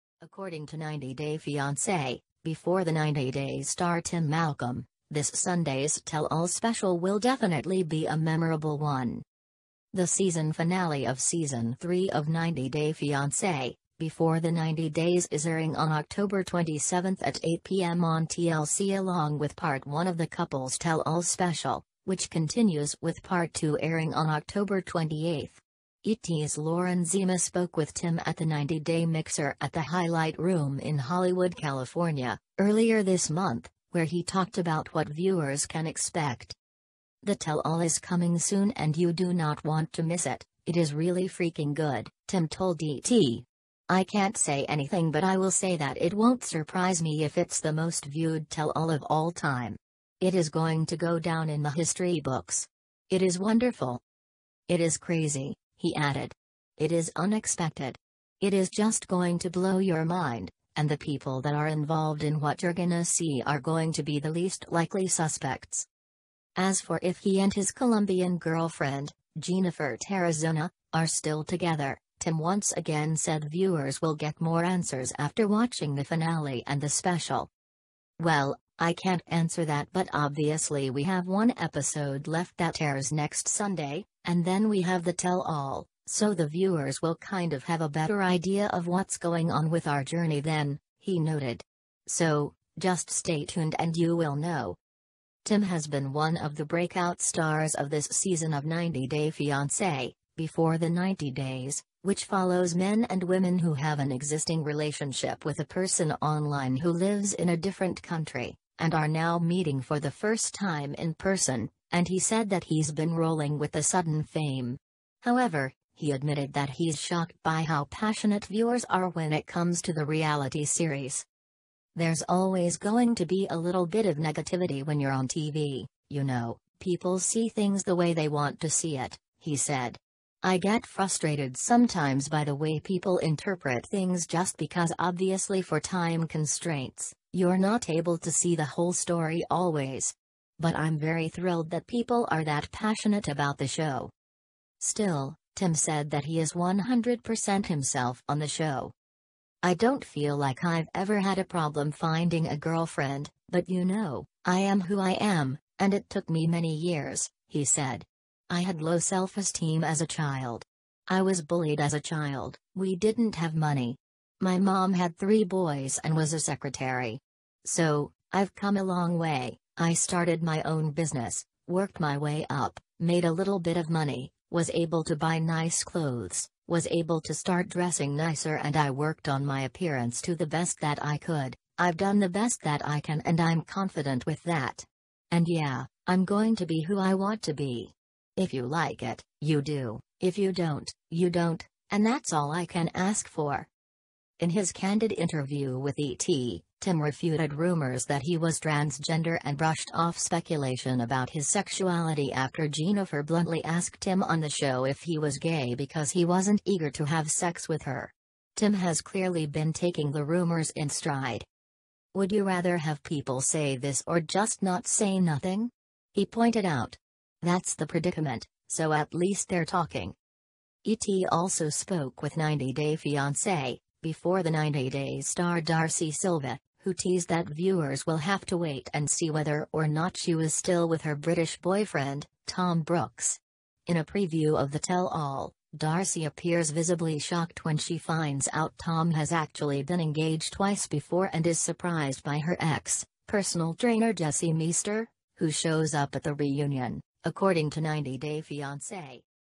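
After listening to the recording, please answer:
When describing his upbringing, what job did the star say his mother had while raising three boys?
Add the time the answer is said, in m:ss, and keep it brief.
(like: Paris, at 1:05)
Secretary, at 2:46.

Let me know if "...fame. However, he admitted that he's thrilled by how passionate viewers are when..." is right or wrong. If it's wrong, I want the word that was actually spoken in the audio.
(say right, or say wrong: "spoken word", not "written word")
wrong: "shocked", not "thrilled".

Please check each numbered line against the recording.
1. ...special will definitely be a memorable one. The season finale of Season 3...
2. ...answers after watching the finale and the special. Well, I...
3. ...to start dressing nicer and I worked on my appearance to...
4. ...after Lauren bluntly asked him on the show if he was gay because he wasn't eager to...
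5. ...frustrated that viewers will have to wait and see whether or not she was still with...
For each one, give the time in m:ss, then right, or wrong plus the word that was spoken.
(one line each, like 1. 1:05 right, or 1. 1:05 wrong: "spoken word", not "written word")
1. 0:06 right
2. 1:14 right
3. 2:57 right
4. 3:22 wrong: "Jennifer", not "Lauren"
5. 3:46 wrong: "teased", not "frustrated".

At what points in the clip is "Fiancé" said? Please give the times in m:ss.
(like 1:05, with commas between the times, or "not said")
0:01, 0:12, 1:39, 3:42, 4:08.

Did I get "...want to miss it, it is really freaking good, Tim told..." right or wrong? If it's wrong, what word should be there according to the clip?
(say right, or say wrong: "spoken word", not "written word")
right.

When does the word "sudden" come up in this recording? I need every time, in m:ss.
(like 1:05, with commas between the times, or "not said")
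1:53.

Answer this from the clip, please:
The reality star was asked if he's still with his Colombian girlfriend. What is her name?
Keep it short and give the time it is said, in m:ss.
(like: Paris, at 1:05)
Jennifer Tarazona, at 1:09.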